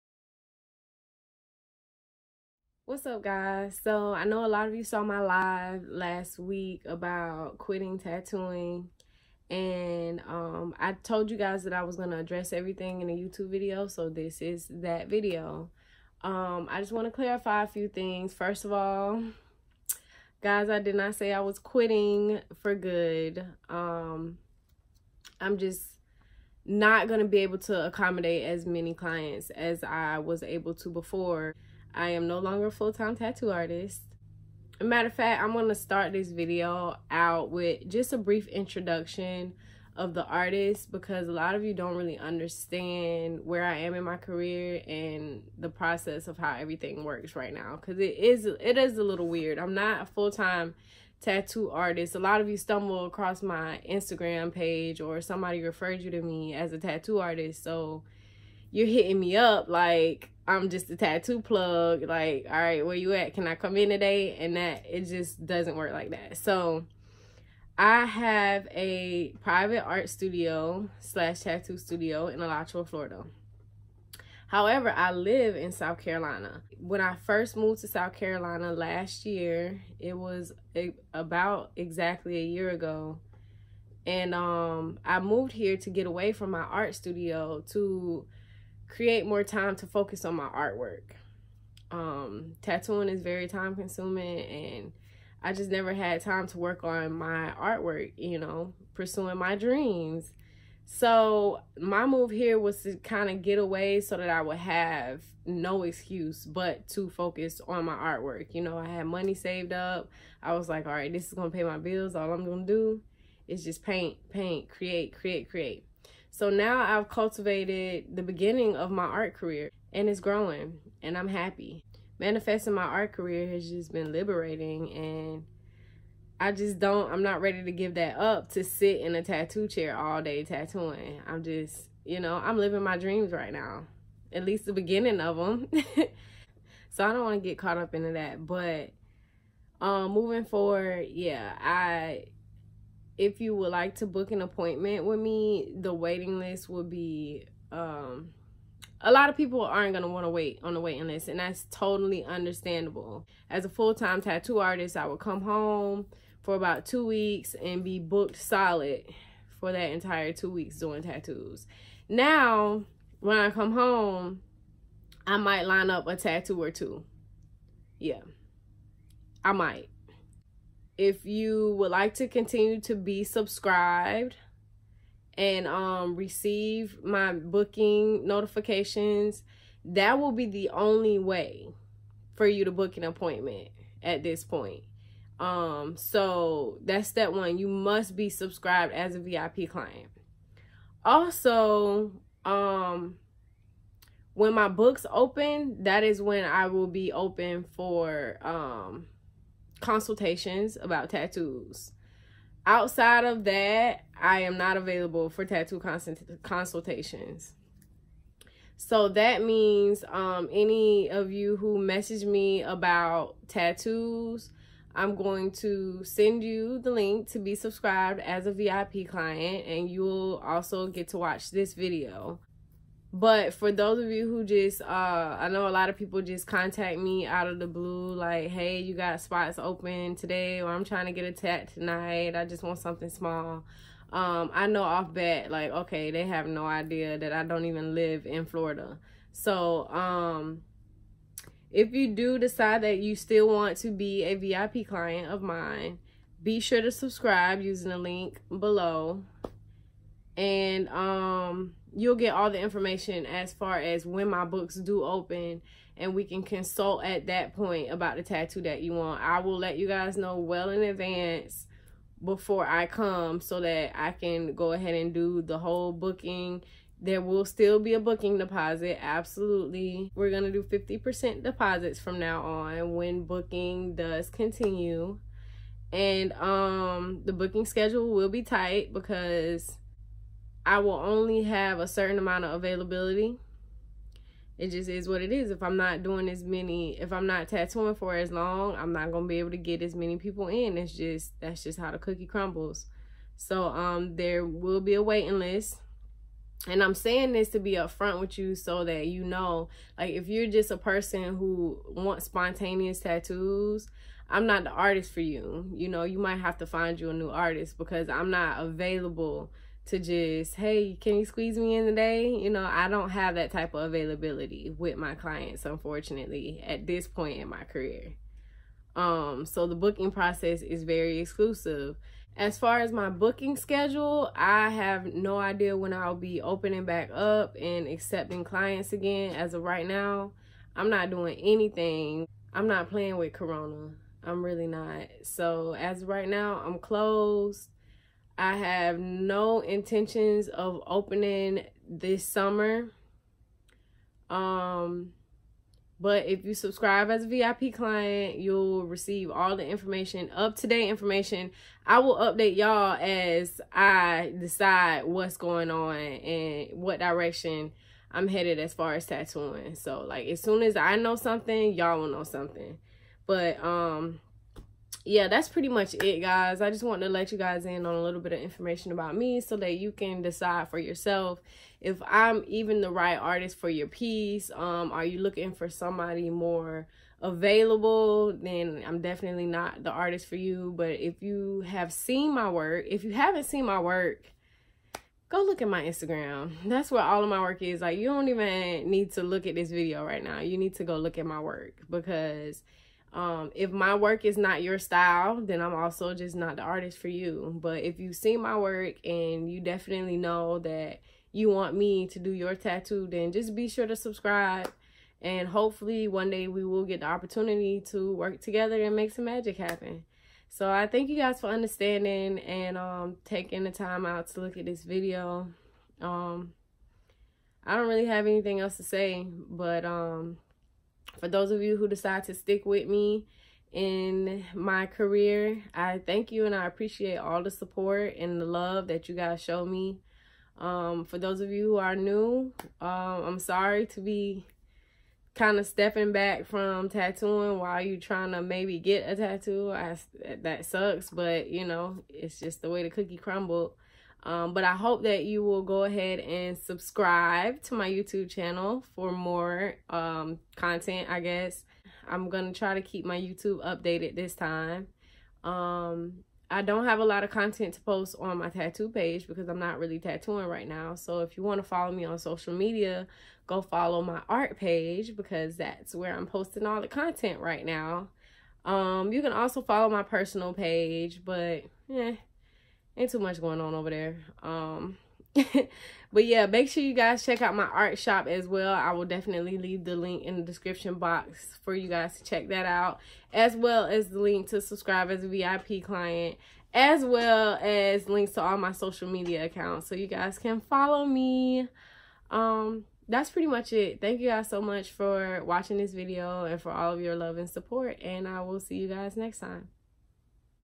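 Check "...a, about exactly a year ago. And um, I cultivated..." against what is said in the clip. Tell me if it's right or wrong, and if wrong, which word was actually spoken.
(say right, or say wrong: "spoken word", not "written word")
wrong: "moved", not "cultivated".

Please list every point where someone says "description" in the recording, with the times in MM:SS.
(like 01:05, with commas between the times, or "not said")
08:00.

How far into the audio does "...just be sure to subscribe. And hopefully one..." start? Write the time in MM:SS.
06:43.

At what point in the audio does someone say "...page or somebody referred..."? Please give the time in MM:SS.
00:54.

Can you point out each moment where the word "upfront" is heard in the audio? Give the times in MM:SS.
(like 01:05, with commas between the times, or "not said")
04:57.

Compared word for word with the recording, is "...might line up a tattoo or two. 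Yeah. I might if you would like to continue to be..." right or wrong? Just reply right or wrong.
right.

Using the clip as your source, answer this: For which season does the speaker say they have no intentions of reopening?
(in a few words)
summer.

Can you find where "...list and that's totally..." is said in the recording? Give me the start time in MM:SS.
02:31.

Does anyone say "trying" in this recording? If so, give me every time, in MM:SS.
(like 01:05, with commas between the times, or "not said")
03:50, 07:18.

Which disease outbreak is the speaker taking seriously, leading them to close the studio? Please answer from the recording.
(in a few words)
Corona.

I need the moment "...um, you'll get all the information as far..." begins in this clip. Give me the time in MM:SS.
04:10.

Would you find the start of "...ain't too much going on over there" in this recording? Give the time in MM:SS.
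07:52.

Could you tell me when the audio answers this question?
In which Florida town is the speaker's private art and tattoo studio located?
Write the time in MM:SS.
01:12.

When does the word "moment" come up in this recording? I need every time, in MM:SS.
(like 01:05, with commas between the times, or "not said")
not said.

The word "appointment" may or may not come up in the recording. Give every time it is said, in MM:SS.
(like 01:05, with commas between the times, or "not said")
02:24, 03:03.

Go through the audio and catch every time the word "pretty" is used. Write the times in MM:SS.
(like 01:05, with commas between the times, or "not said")
06:05, 08:13.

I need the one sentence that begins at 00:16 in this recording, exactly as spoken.
Um, I just want to clarify a few things.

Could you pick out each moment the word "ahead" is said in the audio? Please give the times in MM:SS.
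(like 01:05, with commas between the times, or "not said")
04:24, 07:25.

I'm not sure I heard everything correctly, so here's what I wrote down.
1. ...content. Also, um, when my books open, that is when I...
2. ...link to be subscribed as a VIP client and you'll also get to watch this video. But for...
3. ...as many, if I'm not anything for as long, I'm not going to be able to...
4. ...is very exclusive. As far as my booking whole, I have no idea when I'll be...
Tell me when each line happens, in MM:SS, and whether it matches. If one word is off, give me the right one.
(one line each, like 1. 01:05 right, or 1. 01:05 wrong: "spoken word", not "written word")
1. 03:09 wrong: "client", not "content"
2. 03:36 right
3. 04:46 wrong: "tattooing", not "anything"
4. 05:20 wrong: "schedule", not "whole".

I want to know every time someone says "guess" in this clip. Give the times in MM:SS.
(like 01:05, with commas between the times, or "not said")
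07:31.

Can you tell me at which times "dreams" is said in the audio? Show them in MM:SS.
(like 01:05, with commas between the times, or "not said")
01:39, 02:12.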